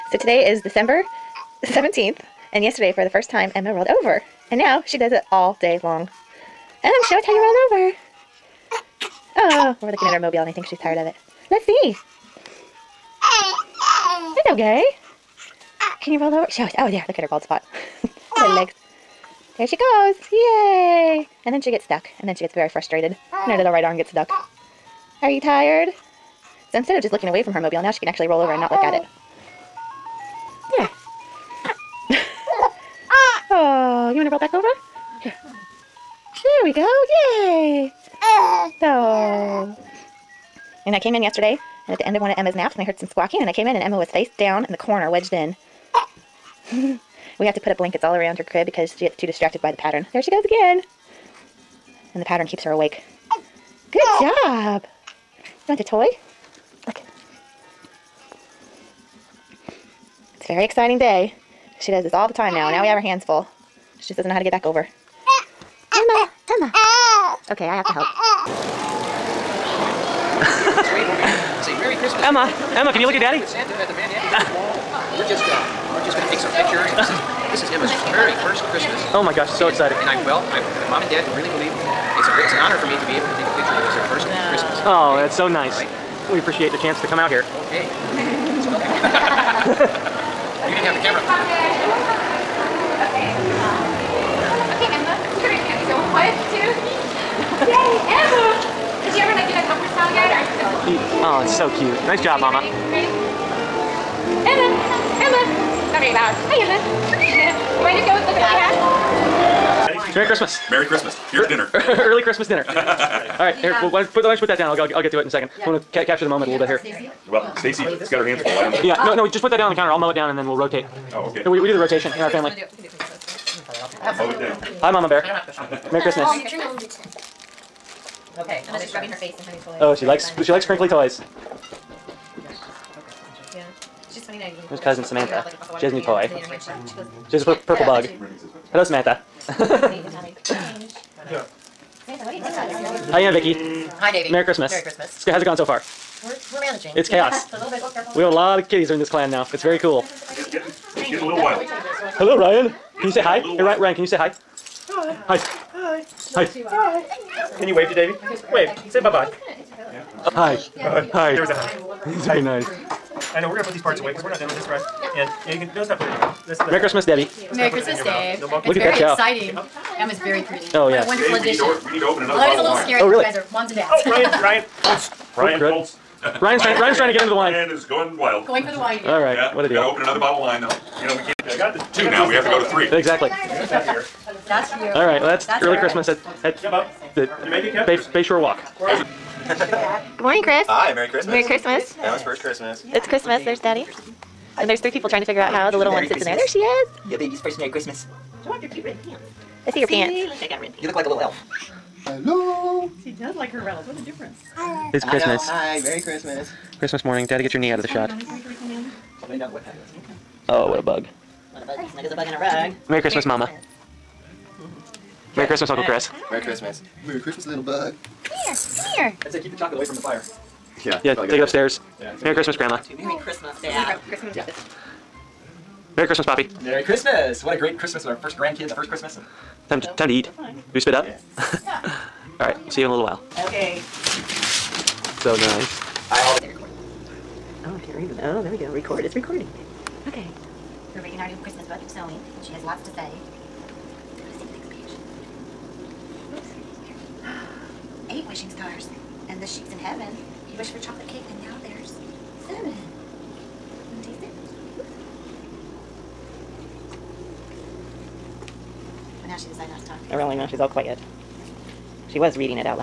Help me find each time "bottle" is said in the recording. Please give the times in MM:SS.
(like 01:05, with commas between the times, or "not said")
02:52, 03:00.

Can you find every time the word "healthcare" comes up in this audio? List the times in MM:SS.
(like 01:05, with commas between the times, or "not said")
not said.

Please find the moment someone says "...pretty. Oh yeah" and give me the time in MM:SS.
02:50.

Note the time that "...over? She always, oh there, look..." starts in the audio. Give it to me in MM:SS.
00:16.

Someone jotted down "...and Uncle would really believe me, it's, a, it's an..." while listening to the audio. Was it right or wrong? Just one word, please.
wrong.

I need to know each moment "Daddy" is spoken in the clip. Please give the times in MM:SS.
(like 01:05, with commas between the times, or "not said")
01:13, 03:13, 03:27.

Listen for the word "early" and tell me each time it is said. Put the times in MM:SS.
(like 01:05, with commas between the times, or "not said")
01:51, 03:05.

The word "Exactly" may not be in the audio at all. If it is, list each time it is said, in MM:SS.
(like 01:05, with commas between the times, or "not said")
03:02.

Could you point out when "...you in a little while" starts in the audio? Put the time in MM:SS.
03:52.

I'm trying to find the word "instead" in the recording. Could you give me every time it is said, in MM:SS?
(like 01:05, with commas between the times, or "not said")
00:26.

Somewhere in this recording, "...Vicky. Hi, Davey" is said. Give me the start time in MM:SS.
02:23.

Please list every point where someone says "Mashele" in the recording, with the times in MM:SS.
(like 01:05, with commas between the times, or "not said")
not said.